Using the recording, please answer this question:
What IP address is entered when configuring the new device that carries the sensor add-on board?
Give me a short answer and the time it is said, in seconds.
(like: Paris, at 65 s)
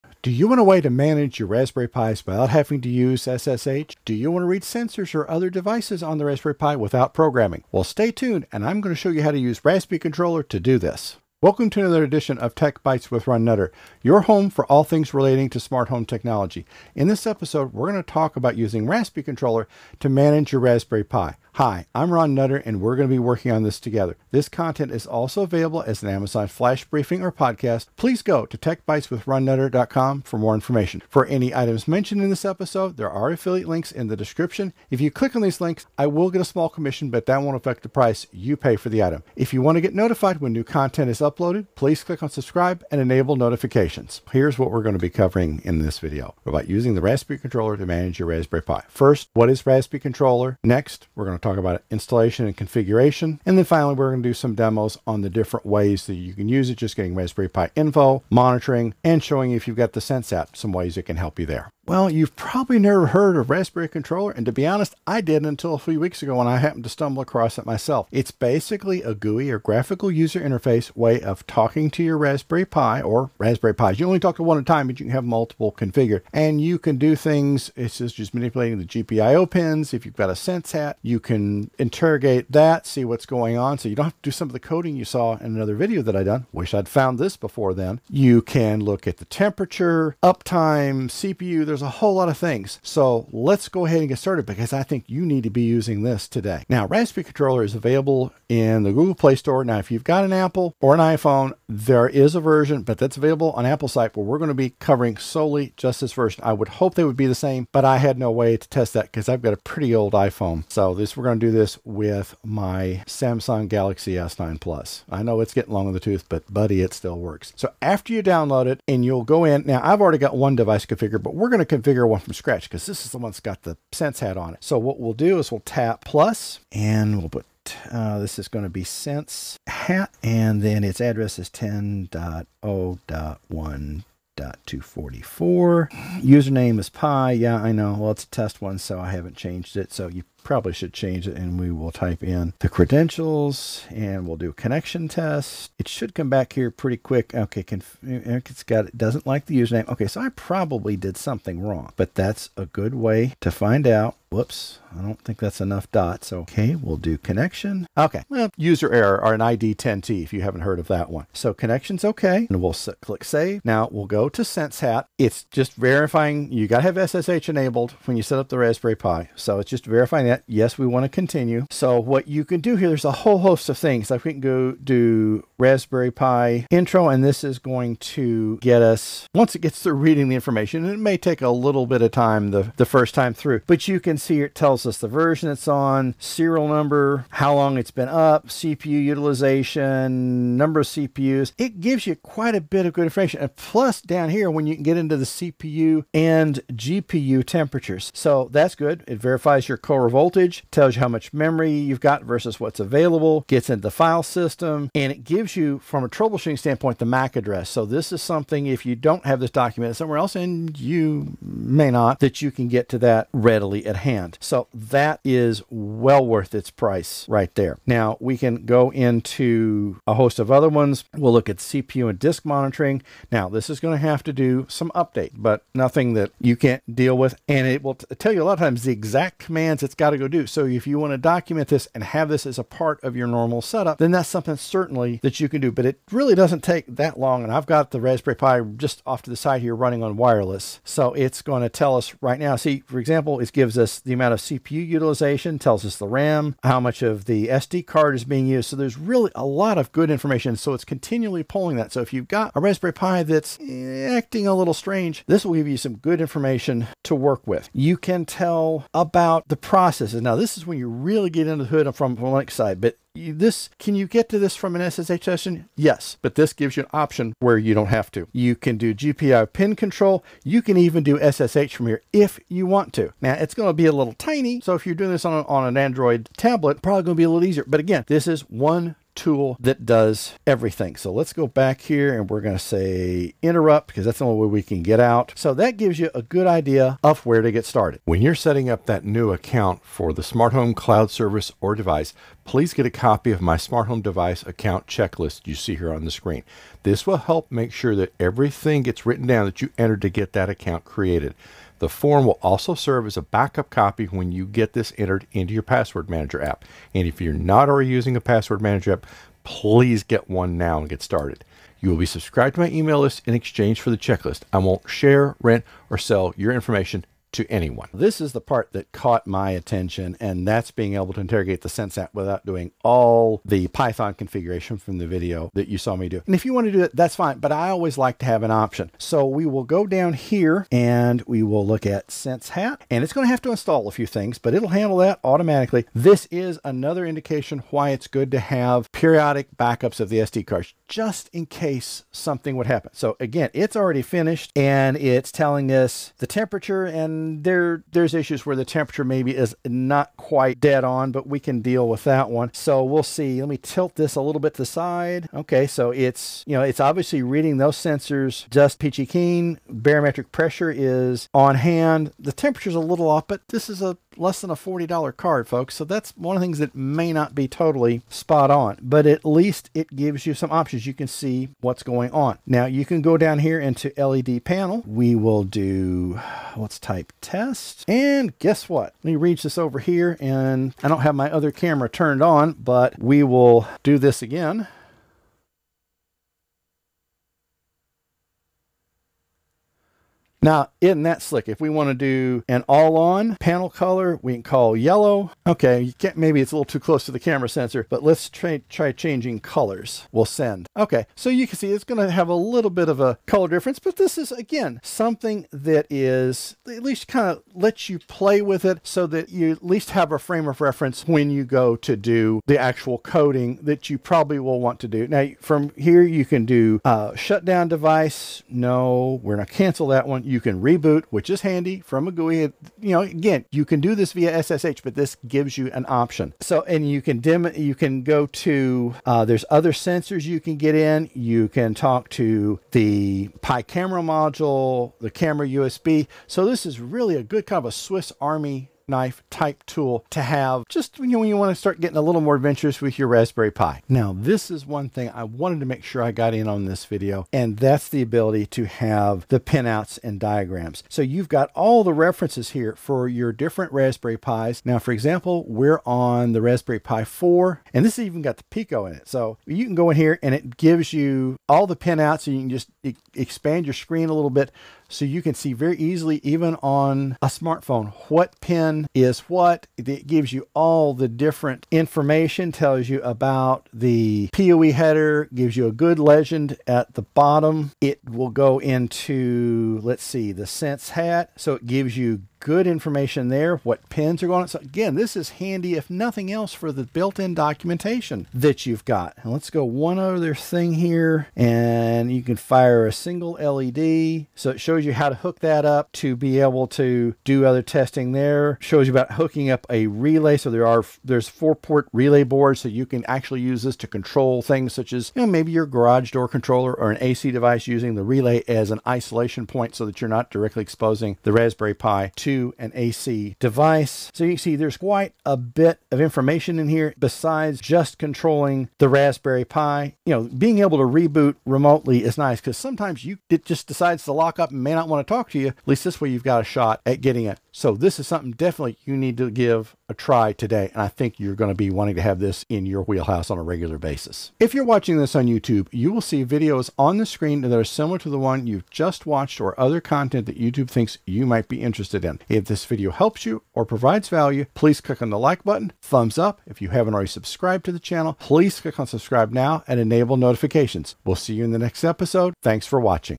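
10.0.1.244, at 131 s.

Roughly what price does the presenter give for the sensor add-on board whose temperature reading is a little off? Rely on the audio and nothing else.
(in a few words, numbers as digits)
less than $40.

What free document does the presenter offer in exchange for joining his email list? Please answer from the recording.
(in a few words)
smart home device account checklist.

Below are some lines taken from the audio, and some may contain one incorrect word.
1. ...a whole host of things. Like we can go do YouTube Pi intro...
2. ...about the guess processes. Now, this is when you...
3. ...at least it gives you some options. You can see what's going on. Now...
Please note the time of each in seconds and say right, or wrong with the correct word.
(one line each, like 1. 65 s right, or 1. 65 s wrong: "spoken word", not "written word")
1. 173 s wrong: "Raspberry", not "YouTube"
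2. 258 s wrong: "process", not "guess"
3. 369 s right.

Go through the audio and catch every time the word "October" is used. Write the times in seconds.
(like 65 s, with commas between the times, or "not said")
not said.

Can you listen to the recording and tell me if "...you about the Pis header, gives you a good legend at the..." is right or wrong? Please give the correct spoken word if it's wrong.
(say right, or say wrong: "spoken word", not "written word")
wrong: "PoE", not "Pis".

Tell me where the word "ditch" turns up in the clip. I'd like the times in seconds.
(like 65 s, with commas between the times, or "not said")
not said.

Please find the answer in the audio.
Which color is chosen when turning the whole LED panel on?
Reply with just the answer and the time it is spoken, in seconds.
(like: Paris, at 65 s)
yellow, at 394 s.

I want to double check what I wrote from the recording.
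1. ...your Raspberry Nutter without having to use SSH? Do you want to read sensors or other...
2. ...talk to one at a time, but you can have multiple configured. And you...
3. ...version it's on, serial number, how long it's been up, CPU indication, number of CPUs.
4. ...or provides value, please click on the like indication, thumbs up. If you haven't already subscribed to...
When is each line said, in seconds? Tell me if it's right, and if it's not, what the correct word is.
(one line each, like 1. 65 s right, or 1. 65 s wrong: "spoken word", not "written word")
1. 1 s wrong: "Pis", not "Nutter"
2. 74 s right
3. 185 s wrong: "utilization", not "indication"
4. 543 s wrong: "button", not "indication".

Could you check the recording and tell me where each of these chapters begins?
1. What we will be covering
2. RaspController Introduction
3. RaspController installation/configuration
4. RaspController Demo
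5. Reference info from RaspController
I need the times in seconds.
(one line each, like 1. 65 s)
1. 44 s
2. 61 s
3. 96 s
4. 317 s
5. 443 s.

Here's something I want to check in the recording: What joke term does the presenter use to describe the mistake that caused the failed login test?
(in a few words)
ID 10T.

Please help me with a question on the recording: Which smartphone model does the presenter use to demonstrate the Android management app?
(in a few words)
Samsung Galaxy S9 Plus.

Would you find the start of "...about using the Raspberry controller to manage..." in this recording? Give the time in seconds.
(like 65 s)
46 s.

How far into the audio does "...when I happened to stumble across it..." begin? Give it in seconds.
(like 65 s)
66 s.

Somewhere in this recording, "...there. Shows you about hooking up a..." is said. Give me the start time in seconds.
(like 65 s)
498 s.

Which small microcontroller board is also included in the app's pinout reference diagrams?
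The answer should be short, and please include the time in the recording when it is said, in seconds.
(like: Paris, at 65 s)
Pico, at 458 s.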